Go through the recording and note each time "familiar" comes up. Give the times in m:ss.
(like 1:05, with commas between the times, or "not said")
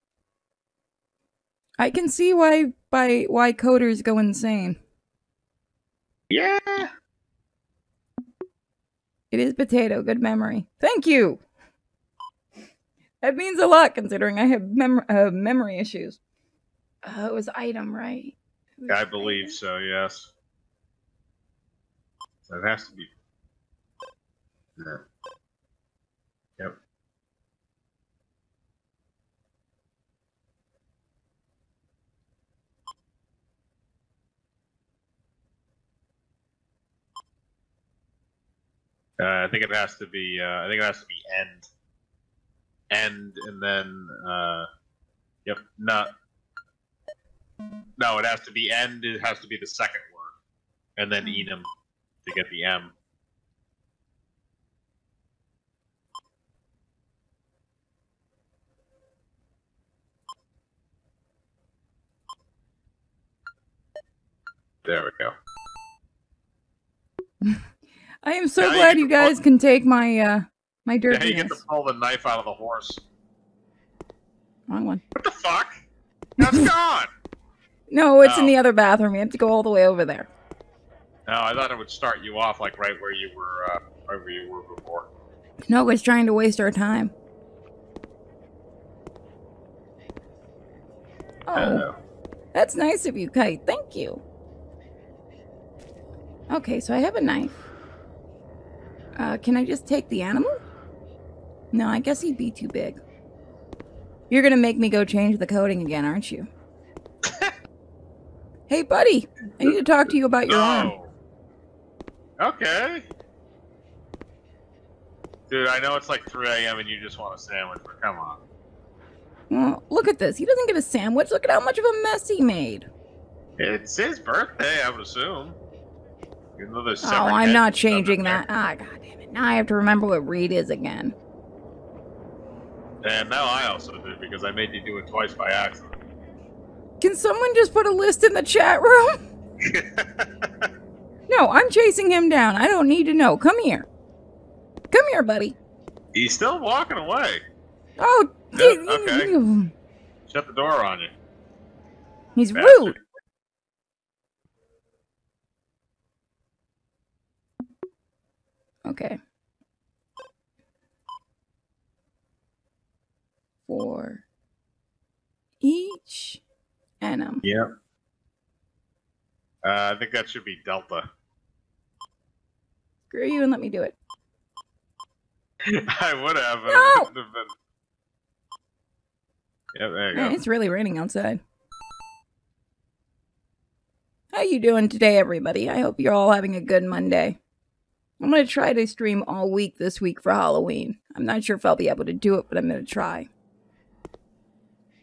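not said.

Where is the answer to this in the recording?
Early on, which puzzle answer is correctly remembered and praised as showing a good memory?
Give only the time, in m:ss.
0:09.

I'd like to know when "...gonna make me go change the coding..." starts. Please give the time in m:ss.
1:44.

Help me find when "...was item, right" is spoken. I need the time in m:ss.
0:17.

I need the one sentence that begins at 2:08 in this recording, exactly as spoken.
Ah, God now I have to remember what Reed is again.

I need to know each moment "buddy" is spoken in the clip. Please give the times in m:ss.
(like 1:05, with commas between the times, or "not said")
1:48, 2:25.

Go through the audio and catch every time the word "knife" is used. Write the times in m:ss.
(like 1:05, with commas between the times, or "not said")
1:11, 1:37.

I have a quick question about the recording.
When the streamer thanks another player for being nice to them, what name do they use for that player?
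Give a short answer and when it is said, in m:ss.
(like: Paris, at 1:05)
Kite, at 1:33.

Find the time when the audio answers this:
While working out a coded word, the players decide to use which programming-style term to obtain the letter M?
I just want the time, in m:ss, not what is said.
0:51.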